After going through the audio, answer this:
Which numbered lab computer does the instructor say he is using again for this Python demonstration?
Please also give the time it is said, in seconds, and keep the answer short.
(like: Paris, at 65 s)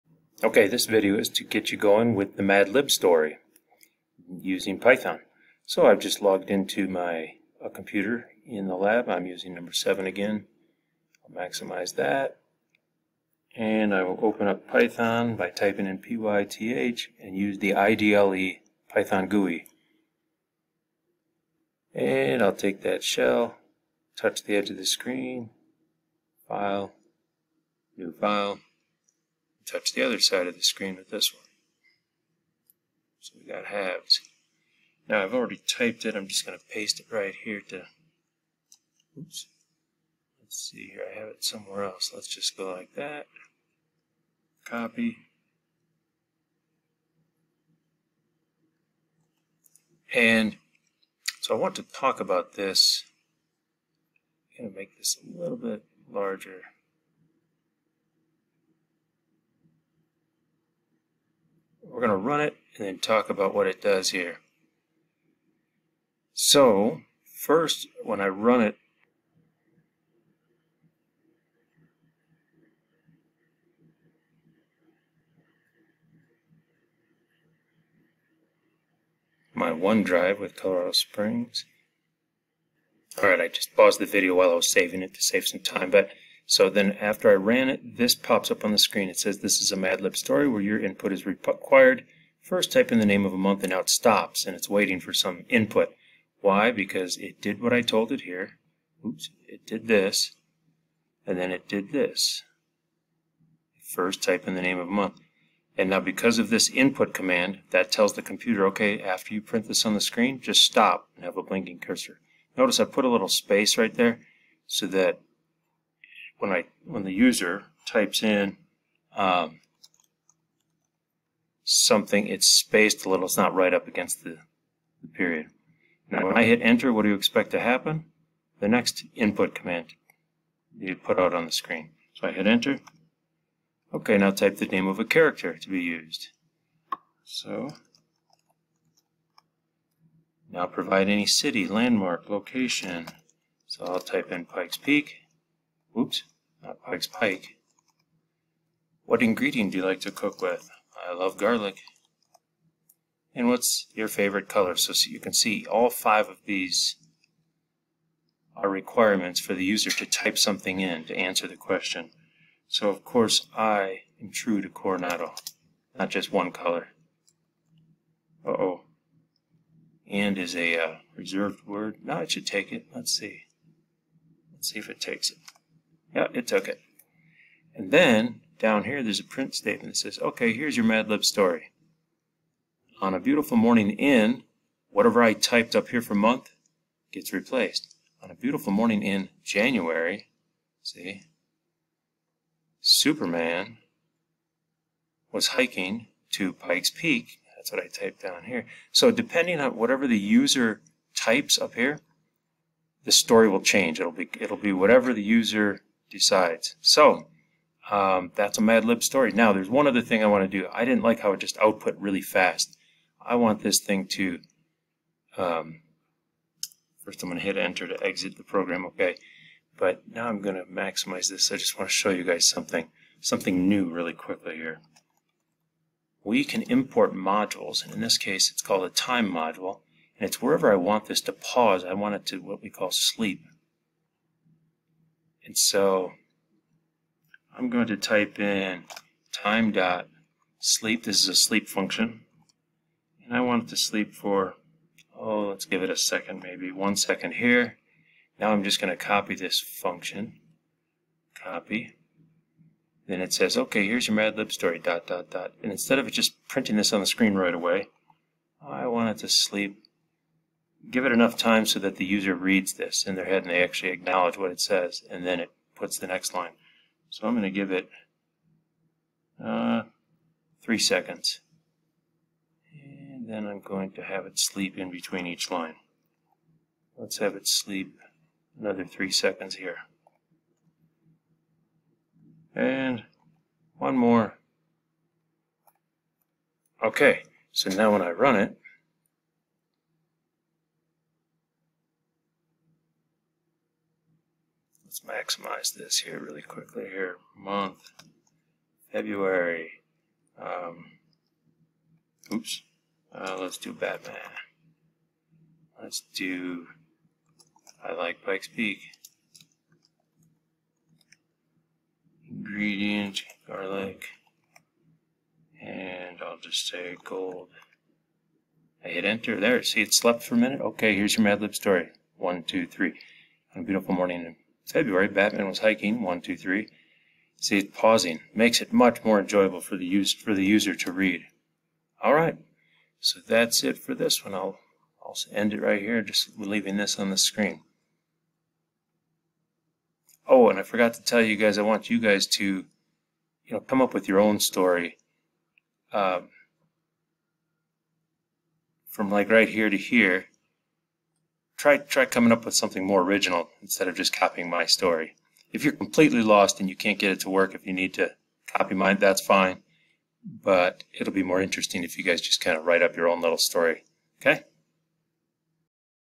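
7, at 9 s.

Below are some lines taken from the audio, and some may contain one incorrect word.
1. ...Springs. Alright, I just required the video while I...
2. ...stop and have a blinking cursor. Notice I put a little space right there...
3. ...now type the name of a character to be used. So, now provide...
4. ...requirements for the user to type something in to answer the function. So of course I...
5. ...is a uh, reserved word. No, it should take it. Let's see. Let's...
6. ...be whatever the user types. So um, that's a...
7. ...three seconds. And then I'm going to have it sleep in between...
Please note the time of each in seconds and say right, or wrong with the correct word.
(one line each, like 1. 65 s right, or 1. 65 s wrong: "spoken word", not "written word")
1. 80 s wrong: "paused", not "required"
2. 110 s right
3. 134 s right
4. 158 s wrong: "question", not "function"
5. 170 s right
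6. 204 s wrong: "decides", not "types"
7. 270 s right.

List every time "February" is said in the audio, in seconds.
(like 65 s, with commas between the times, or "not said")
298 s, 324 s.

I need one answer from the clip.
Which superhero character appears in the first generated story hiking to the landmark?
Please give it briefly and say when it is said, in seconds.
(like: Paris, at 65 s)
Superman, at 192 s.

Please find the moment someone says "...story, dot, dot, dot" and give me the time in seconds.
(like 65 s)
254 s.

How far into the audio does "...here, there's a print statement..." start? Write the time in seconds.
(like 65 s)
178 s.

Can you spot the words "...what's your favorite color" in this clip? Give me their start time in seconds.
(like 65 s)
153 s.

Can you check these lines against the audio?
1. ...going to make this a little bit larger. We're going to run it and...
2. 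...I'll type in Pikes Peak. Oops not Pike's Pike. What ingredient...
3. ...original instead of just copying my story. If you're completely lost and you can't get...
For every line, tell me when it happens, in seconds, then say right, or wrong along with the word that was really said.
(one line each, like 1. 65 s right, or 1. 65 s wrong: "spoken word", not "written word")
1. 54 s right
2. 143 s right
3. 353 s right.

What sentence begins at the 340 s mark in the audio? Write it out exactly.
Oh, and I forgot to tell you guys, I want you guys to, you know, come up with your own story.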